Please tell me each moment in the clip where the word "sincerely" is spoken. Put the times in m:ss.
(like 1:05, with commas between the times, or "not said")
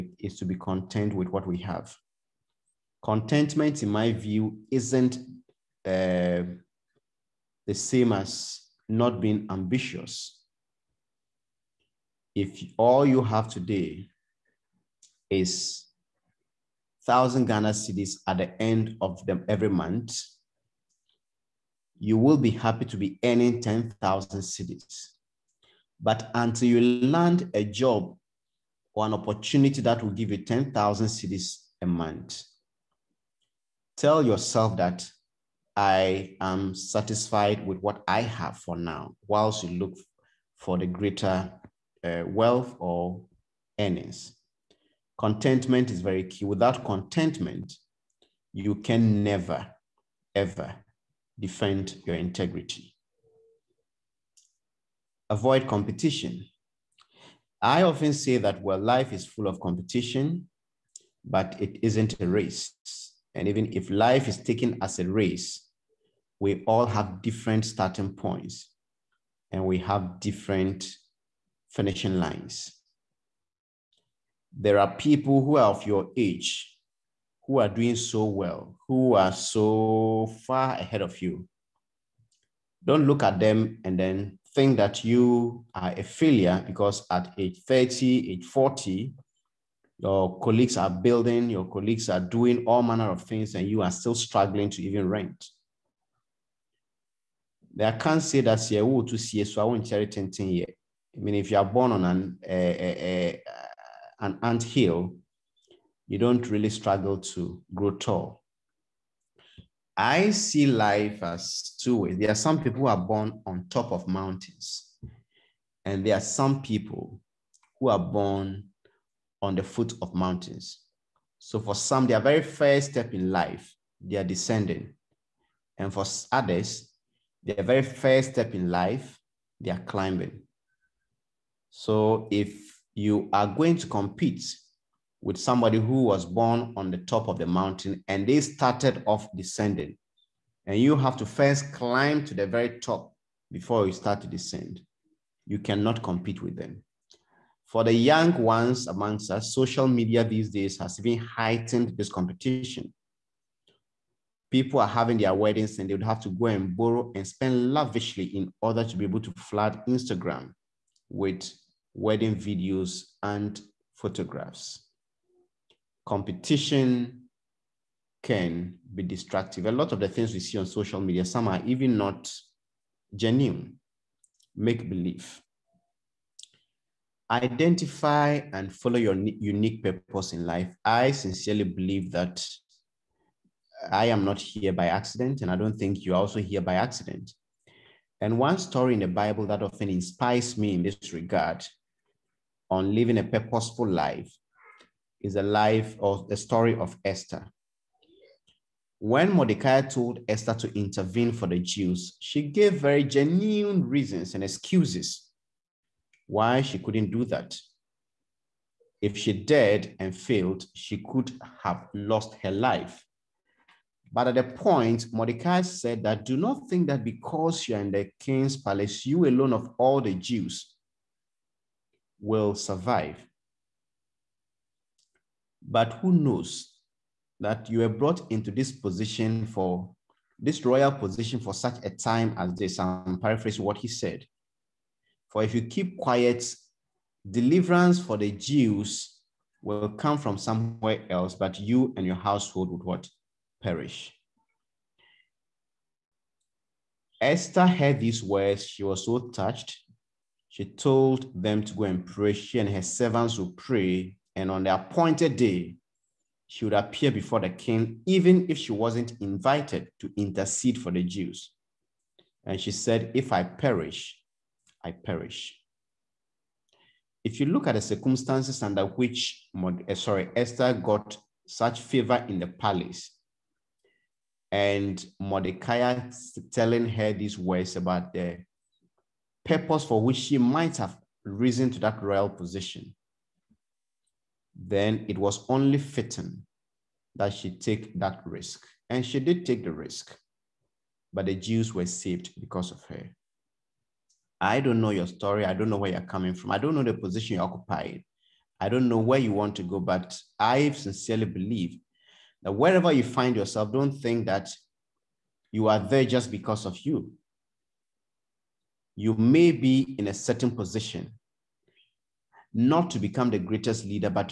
3:01, 5:00.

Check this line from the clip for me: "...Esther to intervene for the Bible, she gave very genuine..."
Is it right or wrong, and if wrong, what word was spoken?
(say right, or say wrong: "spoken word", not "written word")
wrong: "Jews", not "Bible".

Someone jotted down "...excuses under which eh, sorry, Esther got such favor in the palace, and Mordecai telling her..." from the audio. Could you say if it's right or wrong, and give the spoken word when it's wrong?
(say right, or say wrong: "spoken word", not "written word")
wrong: "circumstances", not "excuses".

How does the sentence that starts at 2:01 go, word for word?
So for some, their very first step in life, they are descending.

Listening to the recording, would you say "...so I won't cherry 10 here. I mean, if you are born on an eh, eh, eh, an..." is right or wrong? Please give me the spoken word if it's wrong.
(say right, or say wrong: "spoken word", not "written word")
right.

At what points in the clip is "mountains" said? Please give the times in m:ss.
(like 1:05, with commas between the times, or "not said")
1:54, 2:00, 2:17.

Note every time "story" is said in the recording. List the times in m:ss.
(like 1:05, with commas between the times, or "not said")
3:08, 3:16, 4:55.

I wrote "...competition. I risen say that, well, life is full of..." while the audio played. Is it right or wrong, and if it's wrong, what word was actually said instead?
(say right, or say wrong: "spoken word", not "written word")
wrong: "often", not "risen".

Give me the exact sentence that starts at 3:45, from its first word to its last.
But who knows that you were brought into this position for this royal position for such a time as this?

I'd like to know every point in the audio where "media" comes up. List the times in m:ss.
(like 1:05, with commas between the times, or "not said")
2:29, 2:50.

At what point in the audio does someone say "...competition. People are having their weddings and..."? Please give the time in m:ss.
2:32.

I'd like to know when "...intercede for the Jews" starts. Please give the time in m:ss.
4:20.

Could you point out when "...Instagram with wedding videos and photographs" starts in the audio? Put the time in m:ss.
2:39.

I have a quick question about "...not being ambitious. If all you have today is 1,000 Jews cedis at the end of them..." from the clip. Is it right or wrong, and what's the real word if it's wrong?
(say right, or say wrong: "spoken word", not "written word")
wrong: "Ghana", not "Jews".